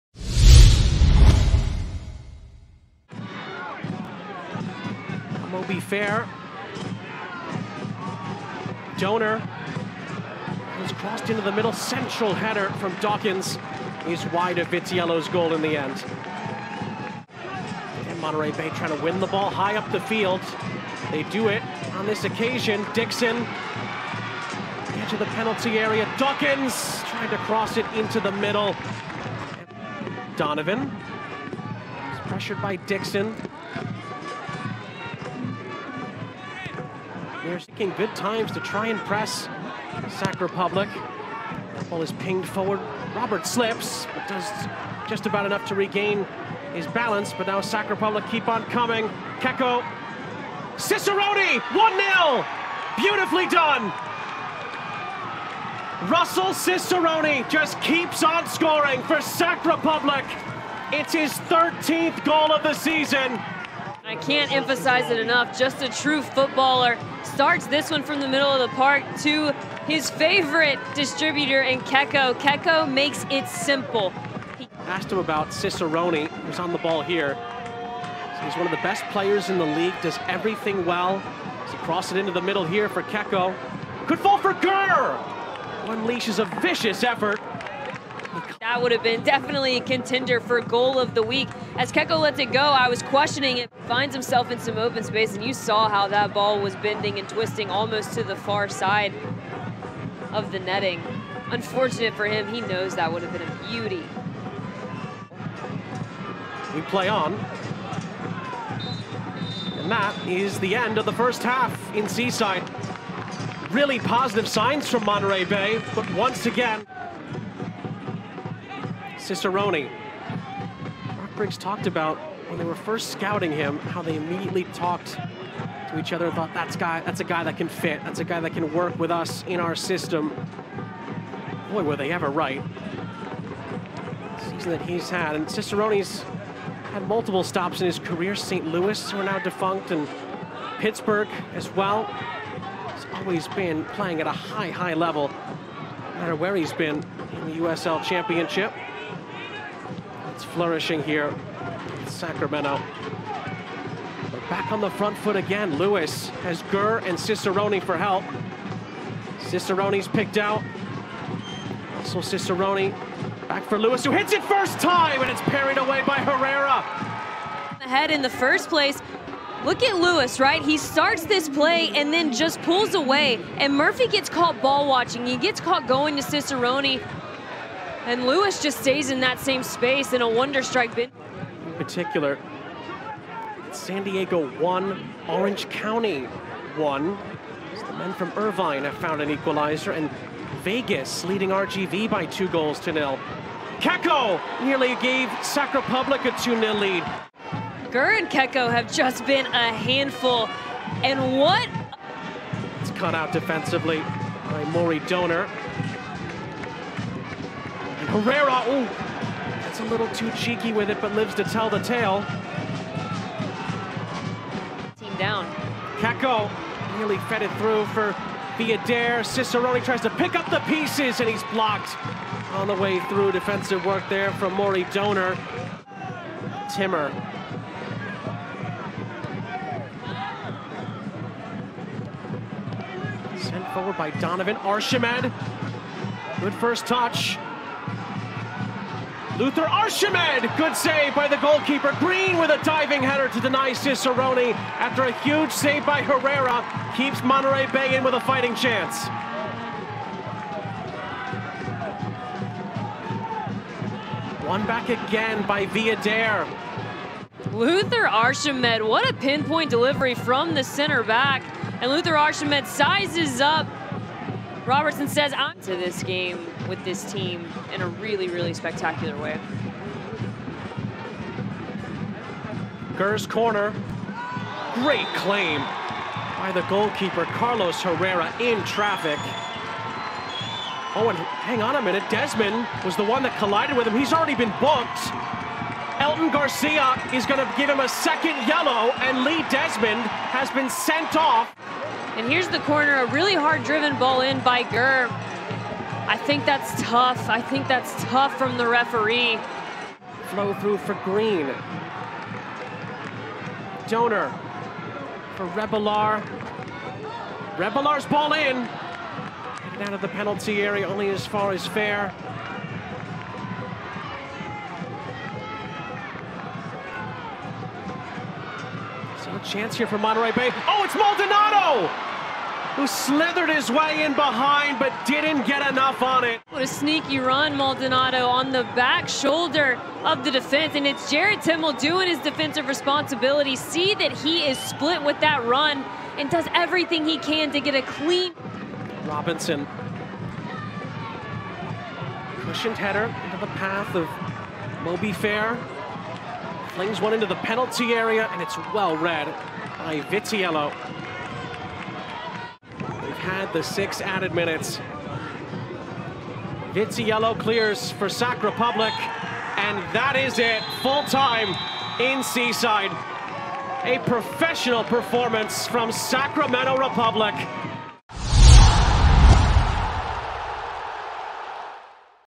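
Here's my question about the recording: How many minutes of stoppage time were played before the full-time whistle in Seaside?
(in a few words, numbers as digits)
6.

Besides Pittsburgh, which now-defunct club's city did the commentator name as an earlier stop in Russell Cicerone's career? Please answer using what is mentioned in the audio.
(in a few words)
St. Louis.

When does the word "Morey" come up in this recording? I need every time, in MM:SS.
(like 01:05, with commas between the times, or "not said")
03:24, 03:44.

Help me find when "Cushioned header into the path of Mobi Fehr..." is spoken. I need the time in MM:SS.
05:42.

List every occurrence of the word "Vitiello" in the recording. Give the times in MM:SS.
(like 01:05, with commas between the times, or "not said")
00:14, 05:50, 05:56.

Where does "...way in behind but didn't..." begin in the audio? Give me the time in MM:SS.
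05:23.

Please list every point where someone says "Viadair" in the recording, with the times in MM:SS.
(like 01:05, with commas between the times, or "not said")
03:38, 04:15.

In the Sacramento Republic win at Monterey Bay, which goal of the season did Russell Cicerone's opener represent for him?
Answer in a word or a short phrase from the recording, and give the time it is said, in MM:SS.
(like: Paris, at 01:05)
13th, at 01:01.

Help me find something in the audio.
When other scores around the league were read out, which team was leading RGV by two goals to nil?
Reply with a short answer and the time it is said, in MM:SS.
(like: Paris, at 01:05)
Vegas, at 03:10.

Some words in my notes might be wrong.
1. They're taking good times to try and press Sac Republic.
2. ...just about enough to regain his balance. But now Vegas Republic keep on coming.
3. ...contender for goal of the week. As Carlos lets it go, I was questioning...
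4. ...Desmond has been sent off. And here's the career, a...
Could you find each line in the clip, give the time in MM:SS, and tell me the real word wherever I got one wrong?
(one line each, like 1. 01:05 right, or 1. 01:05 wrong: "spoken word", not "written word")
1. 00:37 right
2. 00:45 wrong: "Sac", not "Vegas"
3. 01:29 wrong: "Keko", not "Carlos"
4. 04:49 wrong: "corner", not "career".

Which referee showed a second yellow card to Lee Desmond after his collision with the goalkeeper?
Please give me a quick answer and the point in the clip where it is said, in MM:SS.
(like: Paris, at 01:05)
Elton Garcia, at 04:45.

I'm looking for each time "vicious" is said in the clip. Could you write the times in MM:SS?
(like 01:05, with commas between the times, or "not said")
01:26.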